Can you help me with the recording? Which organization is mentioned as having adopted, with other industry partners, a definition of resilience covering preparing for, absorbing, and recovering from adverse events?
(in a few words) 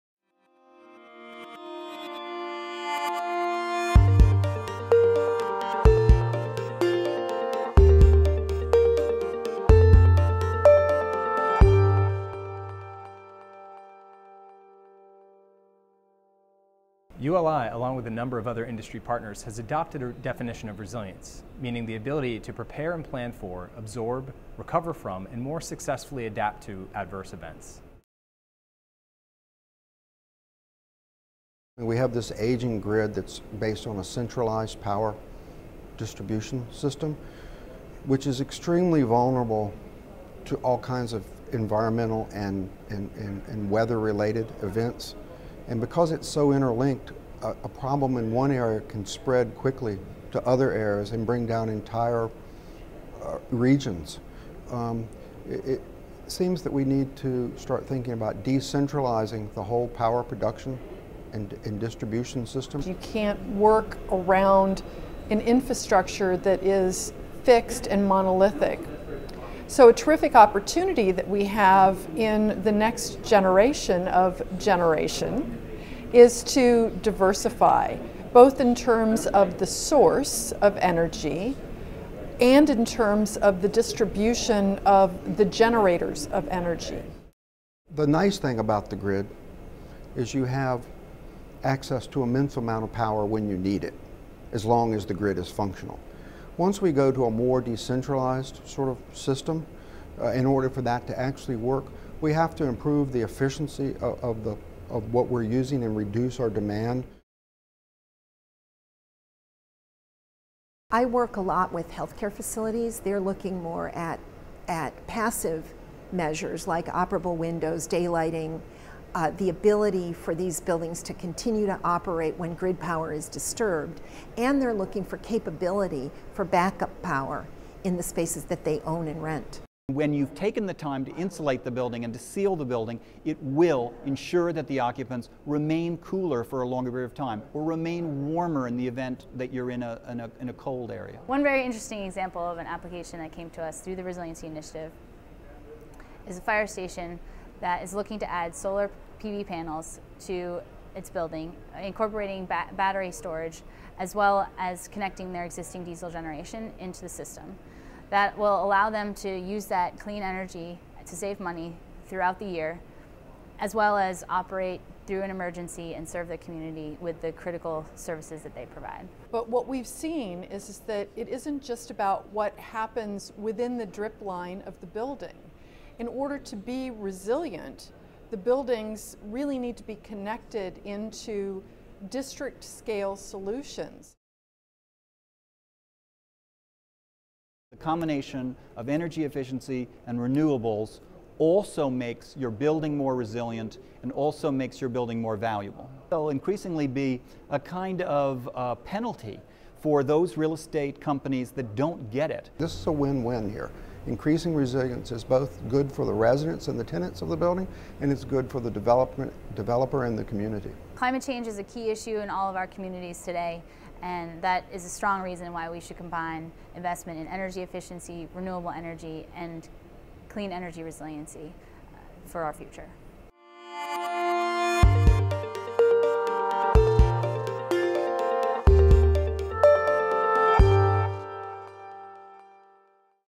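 ULI.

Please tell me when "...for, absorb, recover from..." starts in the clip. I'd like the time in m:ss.
0:23.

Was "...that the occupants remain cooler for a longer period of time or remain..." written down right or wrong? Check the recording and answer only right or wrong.
right.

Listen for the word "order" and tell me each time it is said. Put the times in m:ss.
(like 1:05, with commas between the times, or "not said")
1:40, 2:56.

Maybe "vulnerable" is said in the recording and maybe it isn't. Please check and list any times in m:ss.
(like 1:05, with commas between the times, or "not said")
0:39.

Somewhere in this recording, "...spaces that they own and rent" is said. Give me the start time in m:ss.
2:08.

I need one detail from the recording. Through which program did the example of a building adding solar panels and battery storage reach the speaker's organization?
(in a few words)
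Resiliency Initiative.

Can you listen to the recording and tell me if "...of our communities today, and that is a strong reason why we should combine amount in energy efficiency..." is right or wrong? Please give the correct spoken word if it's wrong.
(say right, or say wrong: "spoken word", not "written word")
wrong: "investment", not "amount".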